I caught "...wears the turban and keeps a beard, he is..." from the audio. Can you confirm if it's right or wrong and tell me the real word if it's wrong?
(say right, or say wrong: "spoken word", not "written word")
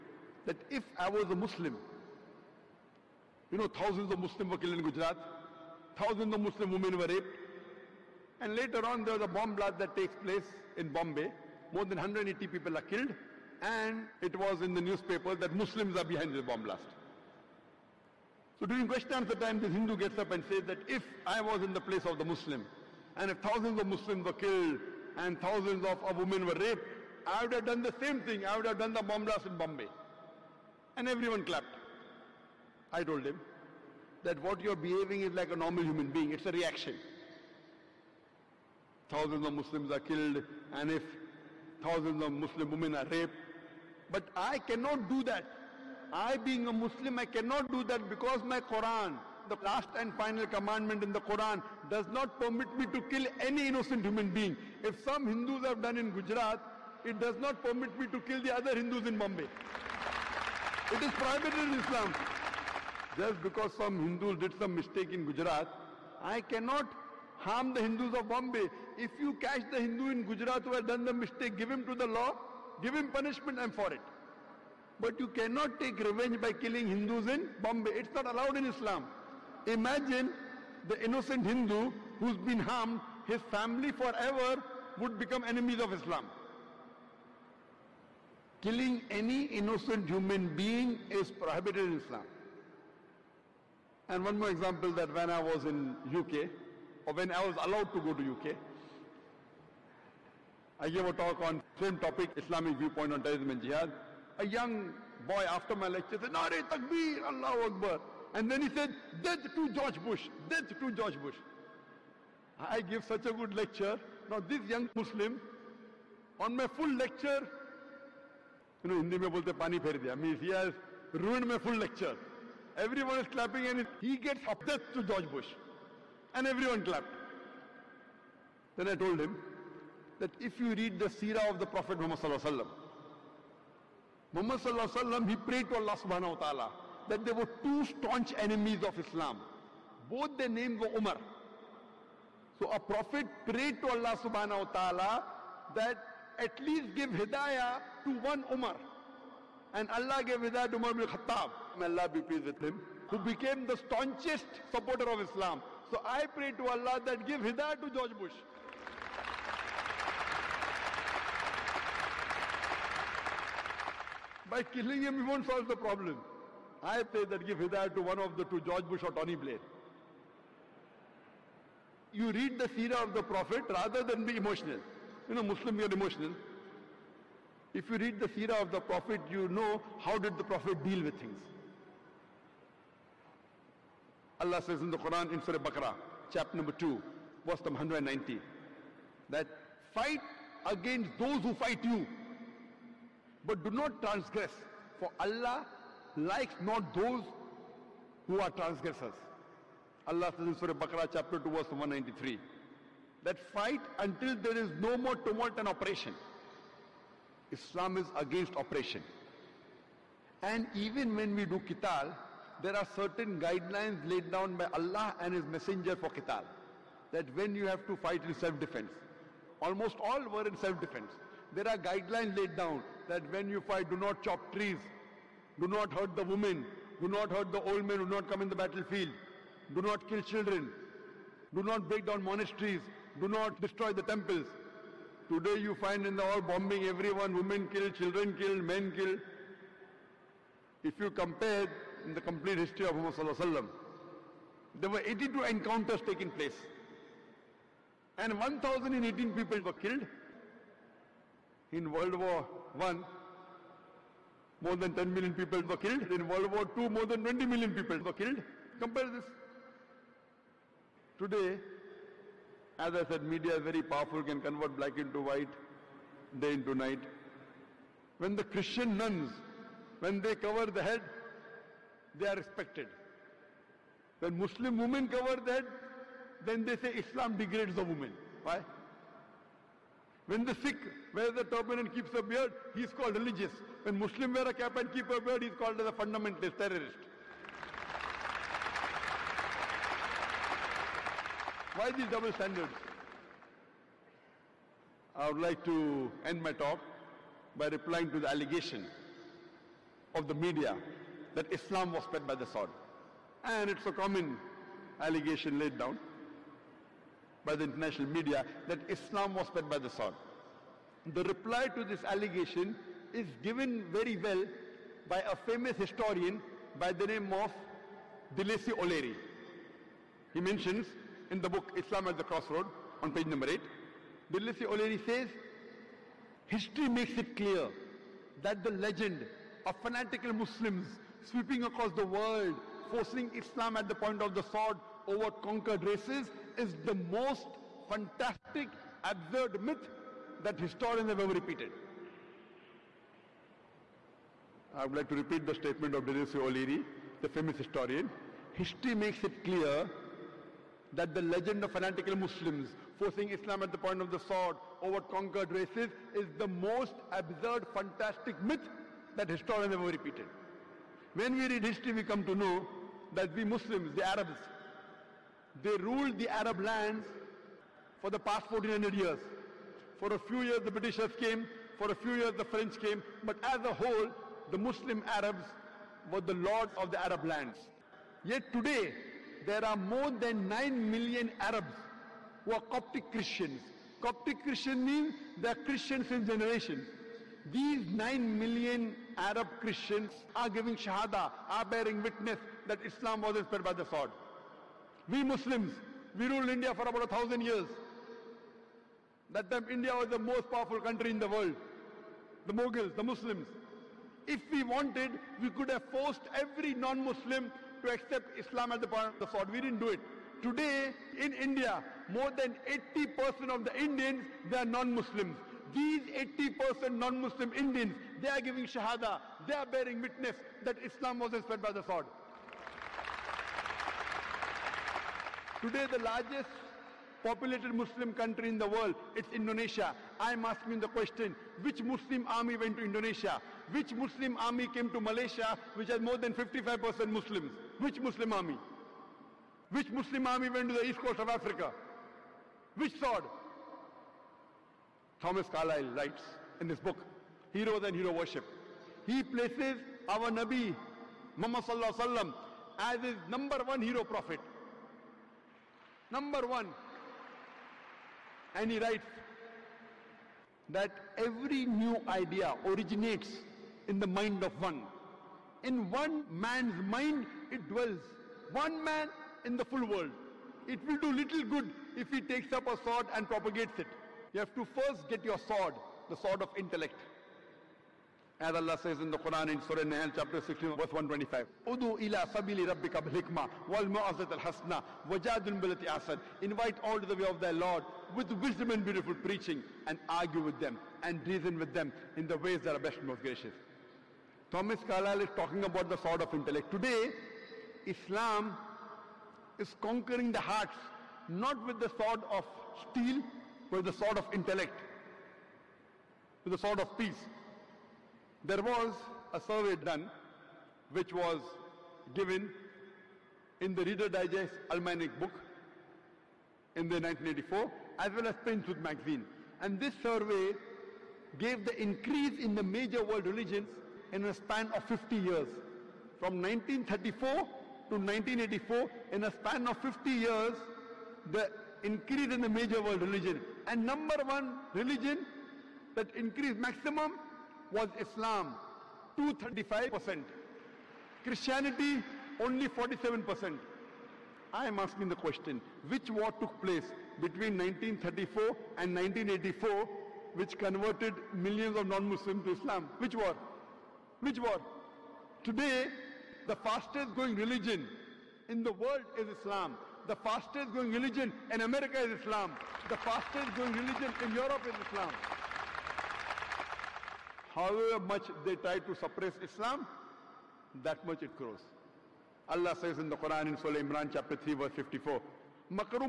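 right.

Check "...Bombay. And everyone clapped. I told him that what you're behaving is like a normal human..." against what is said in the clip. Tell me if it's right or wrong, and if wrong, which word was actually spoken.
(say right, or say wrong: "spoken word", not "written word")
right.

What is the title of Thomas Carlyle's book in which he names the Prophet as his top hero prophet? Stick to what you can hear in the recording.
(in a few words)
Heroes and Hero Worship.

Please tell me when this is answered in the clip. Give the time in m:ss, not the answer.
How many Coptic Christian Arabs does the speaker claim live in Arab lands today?
6:20.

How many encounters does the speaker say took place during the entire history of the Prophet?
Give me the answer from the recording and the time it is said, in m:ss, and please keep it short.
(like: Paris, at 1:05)
82, at 4:05.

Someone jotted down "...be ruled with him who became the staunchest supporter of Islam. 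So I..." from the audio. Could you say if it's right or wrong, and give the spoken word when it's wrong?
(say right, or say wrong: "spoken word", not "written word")
wrong: "pleased", not "ruled".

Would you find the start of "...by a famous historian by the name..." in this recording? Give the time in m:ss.
5:15.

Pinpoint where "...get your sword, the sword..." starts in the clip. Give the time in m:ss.
7:55.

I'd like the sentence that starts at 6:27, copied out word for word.
These 9 million Arab Christians are giving Shahada, are bearing witness that Islam was inspired by the sword.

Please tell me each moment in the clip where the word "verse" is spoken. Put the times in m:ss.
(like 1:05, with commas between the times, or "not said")
3:07, 3:21, 8:00, 9:34.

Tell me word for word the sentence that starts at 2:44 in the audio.
By killing him, you won't solve the problem.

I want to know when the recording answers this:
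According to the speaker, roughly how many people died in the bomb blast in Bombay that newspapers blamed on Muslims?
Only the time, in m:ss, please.
0:11.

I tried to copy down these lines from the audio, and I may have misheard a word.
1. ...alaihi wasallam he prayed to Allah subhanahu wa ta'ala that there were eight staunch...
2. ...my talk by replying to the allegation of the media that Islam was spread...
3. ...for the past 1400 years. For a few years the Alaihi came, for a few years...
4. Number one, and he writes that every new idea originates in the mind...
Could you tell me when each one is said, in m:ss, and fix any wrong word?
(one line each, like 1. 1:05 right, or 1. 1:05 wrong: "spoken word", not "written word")
1. 2:14 wrong: "two", not "eight"
2. 4:56 right
3. 6:08 wrong: "Britishers", not "Alaihi"
4. 7:36 right.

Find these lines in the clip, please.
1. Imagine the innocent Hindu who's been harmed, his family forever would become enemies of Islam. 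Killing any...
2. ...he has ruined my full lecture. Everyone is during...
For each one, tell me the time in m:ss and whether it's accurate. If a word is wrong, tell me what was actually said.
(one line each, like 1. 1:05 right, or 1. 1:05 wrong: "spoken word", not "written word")
1. 1:19 right
2. 2:00 wrong: "clapping", not "during".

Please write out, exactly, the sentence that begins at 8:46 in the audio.
From 1934 to 1984, in a span of 50 years, the increase in the major world religion.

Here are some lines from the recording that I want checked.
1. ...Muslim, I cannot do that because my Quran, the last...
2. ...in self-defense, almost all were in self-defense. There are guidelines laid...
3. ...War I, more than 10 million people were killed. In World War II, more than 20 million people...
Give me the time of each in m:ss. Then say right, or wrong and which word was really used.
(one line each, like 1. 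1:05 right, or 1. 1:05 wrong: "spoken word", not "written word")
1. 0:46 right
2. 3:38 right
3. 4:12 right.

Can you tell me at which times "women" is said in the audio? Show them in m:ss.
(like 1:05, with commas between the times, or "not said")
0:06, 0:26, 0:42, 3:46, 3:57, 4:34.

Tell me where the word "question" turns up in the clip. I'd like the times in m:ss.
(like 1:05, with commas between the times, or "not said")
0:18, 7:10, 9:05.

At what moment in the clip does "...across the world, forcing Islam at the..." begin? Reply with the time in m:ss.
5:31.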